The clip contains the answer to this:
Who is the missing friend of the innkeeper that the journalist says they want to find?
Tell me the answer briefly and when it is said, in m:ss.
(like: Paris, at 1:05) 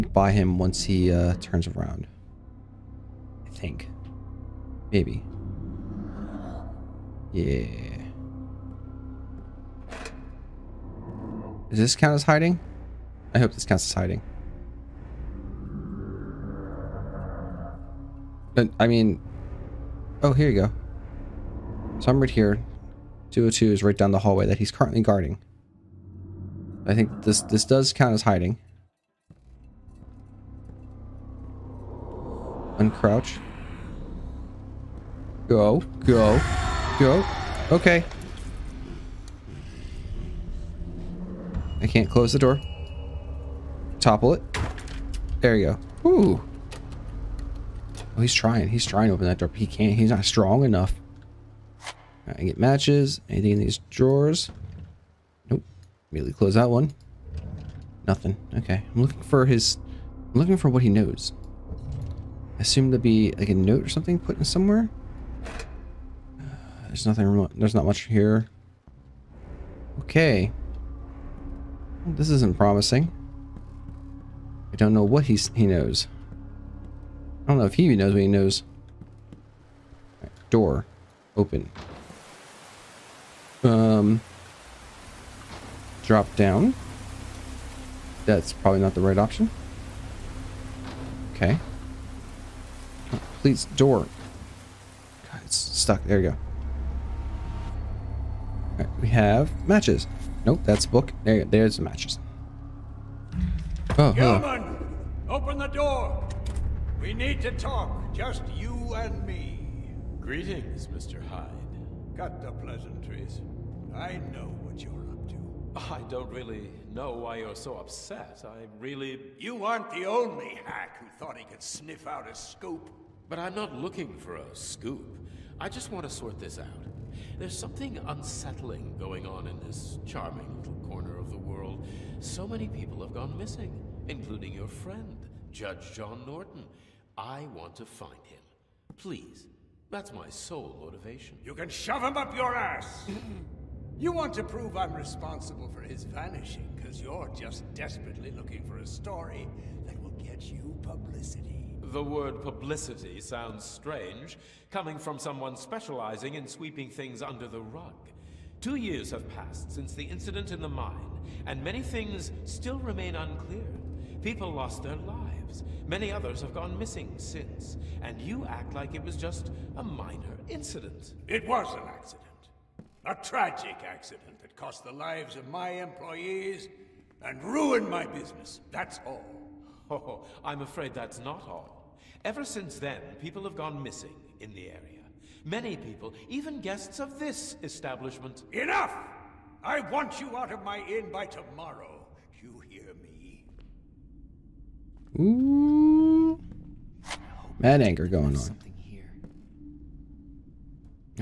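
Judge John Norton, at 2:15.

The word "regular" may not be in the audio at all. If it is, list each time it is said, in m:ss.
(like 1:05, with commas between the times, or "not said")
not said.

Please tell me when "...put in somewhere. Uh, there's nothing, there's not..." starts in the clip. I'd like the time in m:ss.
1:04.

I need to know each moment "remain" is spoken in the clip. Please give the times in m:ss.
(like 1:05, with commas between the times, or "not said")
2:42.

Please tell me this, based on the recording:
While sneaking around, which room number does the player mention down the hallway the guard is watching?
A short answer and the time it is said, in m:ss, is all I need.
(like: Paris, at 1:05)
202, at 0:23.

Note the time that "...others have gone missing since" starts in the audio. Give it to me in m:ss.
2:46.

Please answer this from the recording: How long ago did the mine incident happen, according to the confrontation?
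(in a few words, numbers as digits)
2 years.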